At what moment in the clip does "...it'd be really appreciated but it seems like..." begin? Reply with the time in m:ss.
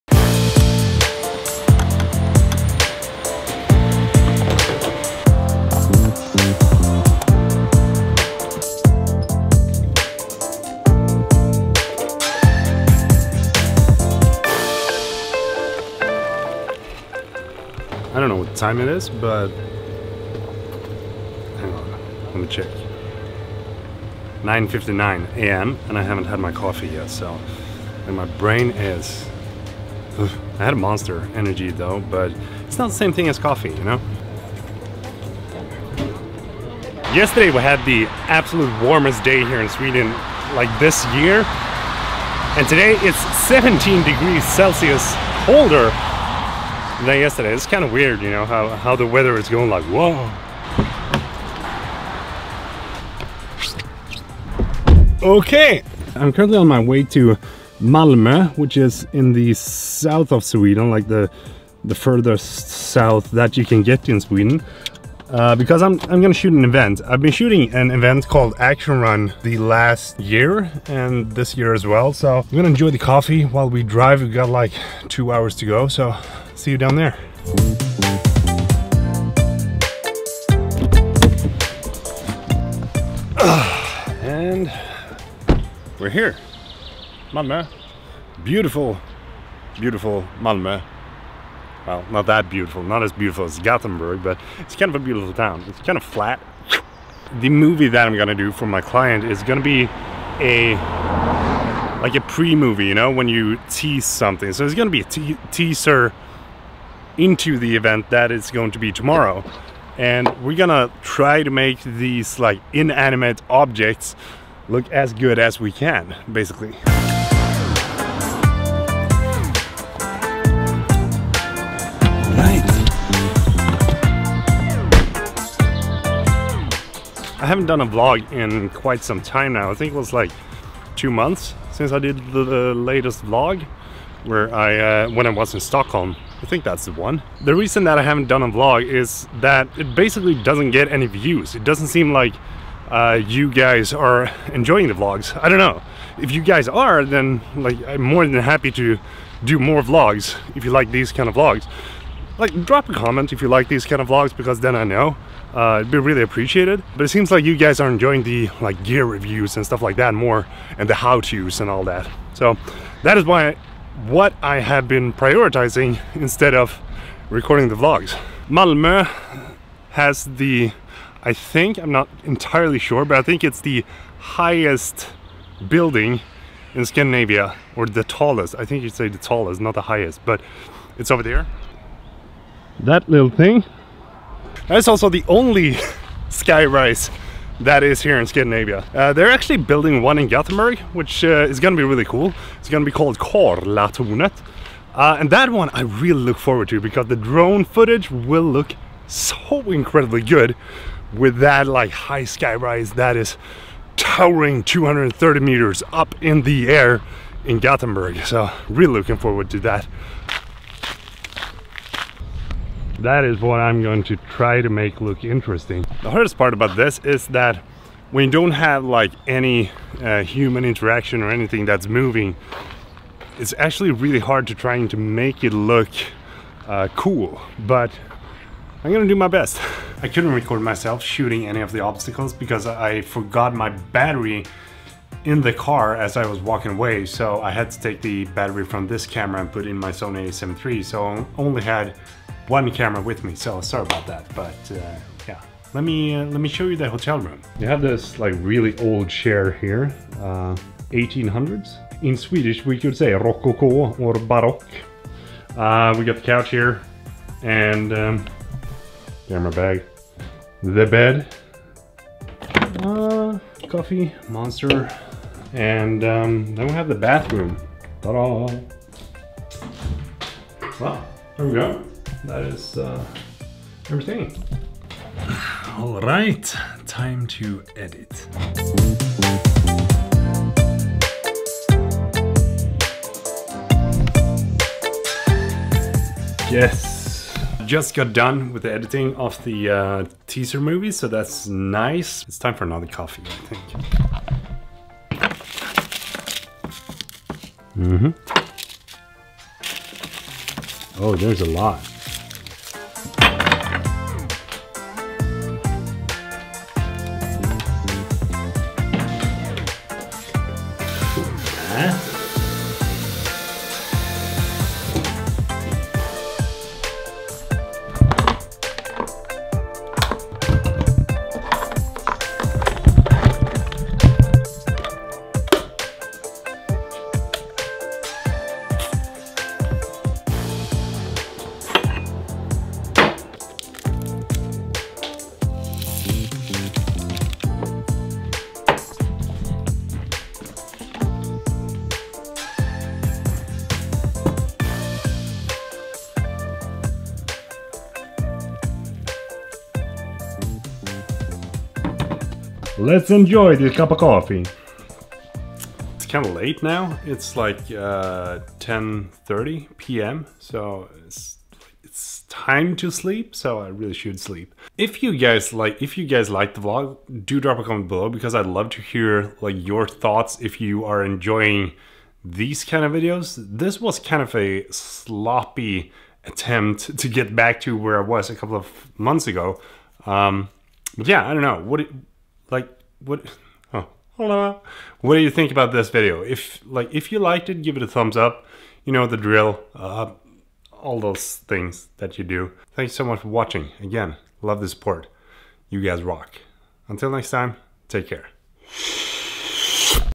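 2:35.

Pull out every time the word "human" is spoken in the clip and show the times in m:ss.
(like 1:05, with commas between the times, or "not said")
3:40.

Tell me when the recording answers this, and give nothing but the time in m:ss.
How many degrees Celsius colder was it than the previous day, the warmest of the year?
0:43.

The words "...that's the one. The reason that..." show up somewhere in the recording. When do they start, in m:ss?
2:16.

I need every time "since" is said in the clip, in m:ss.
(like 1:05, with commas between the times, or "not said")
2:11.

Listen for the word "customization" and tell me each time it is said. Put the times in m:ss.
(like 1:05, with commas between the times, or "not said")
not said.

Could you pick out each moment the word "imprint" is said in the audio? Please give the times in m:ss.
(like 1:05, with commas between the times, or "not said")
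not said.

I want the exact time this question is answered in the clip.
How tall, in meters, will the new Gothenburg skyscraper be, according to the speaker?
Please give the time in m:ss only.
3:24.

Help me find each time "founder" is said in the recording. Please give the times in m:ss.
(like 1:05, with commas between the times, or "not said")
not said.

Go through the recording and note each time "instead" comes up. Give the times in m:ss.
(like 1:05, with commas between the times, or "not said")
2:46.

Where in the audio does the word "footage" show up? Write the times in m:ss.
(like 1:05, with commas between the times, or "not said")
3:17.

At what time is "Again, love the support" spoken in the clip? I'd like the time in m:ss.
6:33.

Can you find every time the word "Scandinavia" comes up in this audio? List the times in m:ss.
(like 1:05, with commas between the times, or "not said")
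2:56, 3:08.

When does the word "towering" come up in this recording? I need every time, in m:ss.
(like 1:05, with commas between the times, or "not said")
3:23.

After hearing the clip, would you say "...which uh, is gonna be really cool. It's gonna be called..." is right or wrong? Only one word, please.
right.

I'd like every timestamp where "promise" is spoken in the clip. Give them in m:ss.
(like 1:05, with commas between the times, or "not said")
not said.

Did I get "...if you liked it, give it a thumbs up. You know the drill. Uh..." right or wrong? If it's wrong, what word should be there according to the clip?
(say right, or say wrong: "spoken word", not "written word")
right.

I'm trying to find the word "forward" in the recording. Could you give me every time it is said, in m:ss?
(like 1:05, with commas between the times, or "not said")
3:16, 3:29.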